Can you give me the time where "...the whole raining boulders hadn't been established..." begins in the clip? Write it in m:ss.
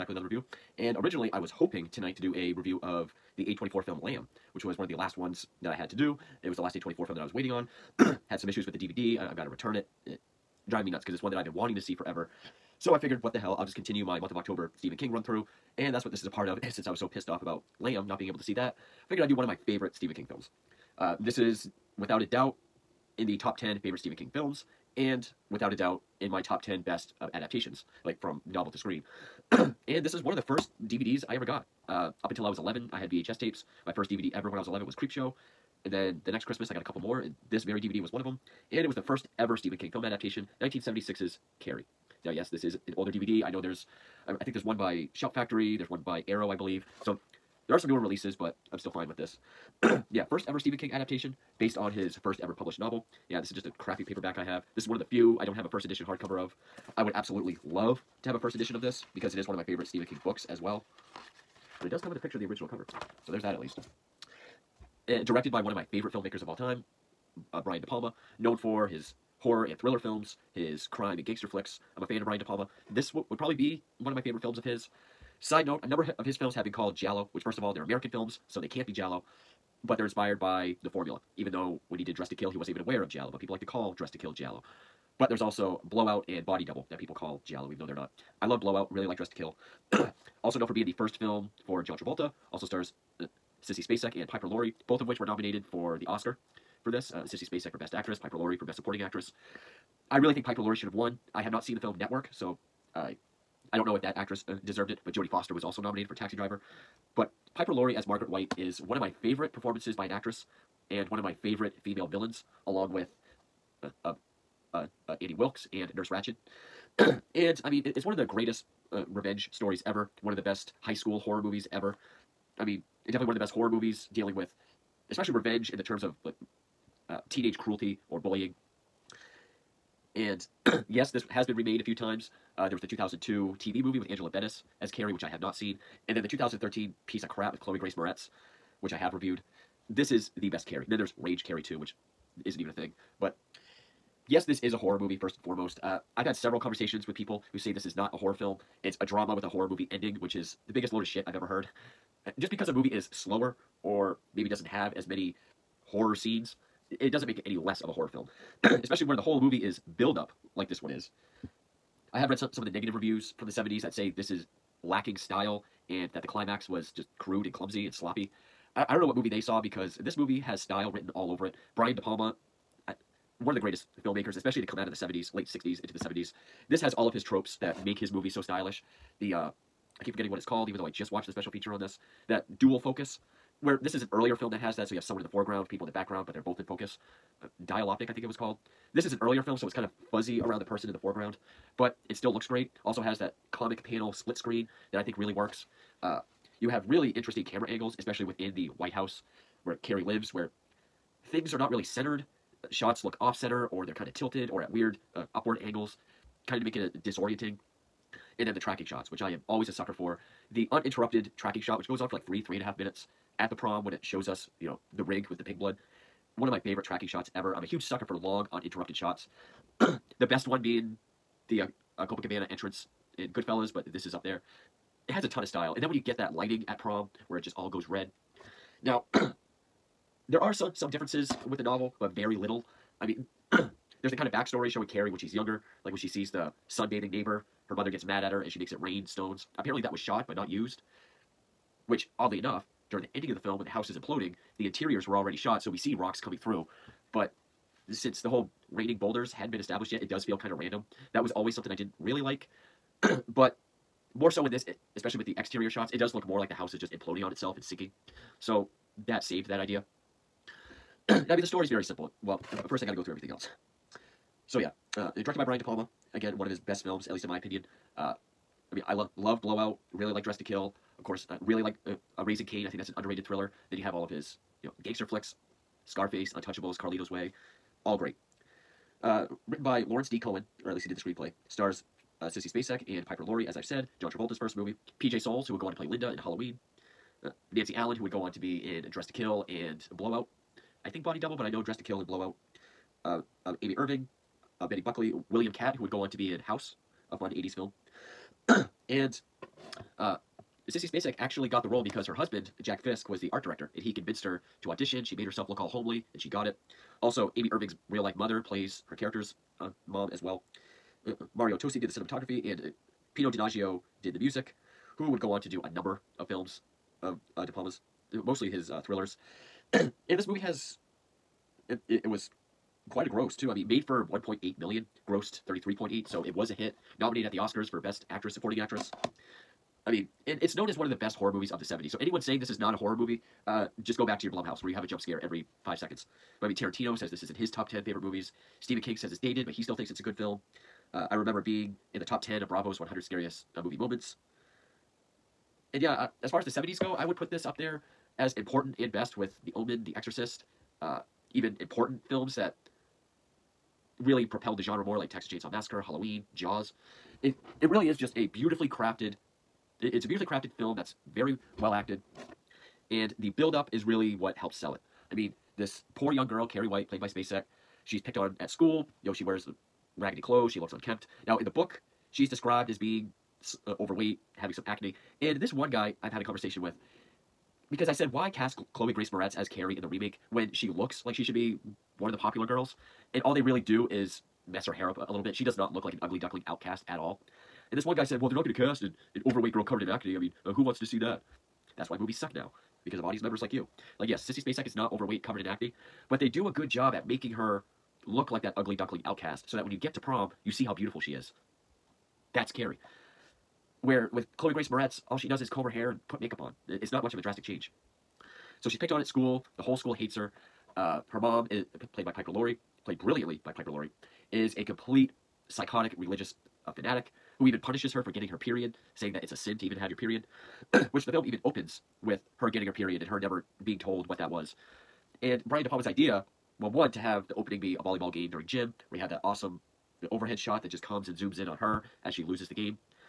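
4:08.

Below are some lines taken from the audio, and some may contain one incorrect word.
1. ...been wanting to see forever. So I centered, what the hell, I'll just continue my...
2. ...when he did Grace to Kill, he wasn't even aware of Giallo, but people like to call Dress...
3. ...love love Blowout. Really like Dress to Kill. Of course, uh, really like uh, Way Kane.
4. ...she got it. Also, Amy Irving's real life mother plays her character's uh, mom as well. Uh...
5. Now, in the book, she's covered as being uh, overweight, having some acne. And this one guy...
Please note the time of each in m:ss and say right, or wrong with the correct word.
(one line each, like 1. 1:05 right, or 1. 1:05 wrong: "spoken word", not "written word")
1. 0:11 wrong: "figured", not "centered"
2. 1:21 wrong: "Dress", not "Grace"
3. 4:28 wrong: "Raising", not "Way"
4. 5:06 right
5. 6:11 wrong: "described", not "covered".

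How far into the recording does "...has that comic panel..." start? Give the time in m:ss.
3:13.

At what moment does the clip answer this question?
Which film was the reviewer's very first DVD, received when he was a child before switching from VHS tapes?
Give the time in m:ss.
0:34.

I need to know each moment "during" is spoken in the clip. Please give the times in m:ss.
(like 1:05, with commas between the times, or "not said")
4:02, 7:08.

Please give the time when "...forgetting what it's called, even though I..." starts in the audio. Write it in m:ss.
3:00.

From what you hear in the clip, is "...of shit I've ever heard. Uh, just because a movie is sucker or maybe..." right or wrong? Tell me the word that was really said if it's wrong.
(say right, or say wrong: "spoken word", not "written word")
wrong: "slower", not "sucker".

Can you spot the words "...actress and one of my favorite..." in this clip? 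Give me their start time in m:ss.
1:50.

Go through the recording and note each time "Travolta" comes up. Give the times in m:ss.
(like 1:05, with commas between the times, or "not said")
1:31, 4:44.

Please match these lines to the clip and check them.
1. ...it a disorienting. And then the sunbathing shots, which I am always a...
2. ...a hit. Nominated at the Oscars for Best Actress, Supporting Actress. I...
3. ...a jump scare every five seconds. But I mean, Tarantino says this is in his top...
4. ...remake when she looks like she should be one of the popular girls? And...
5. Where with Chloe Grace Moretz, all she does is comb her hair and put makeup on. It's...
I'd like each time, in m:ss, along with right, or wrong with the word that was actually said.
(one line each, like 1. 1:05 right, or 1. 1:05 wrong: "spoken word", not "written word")
1. 3:26 wrong: "tracking", not "sunbathing"
2. 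5:26 right
3. 5:34 right
4. 6:19 right
5. 6:43 right.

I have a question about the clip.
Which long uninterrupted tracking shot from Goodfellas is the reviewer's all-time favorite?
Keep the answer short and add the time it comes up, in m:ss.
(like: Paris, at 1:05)
Copacabana entrance, at 3:42.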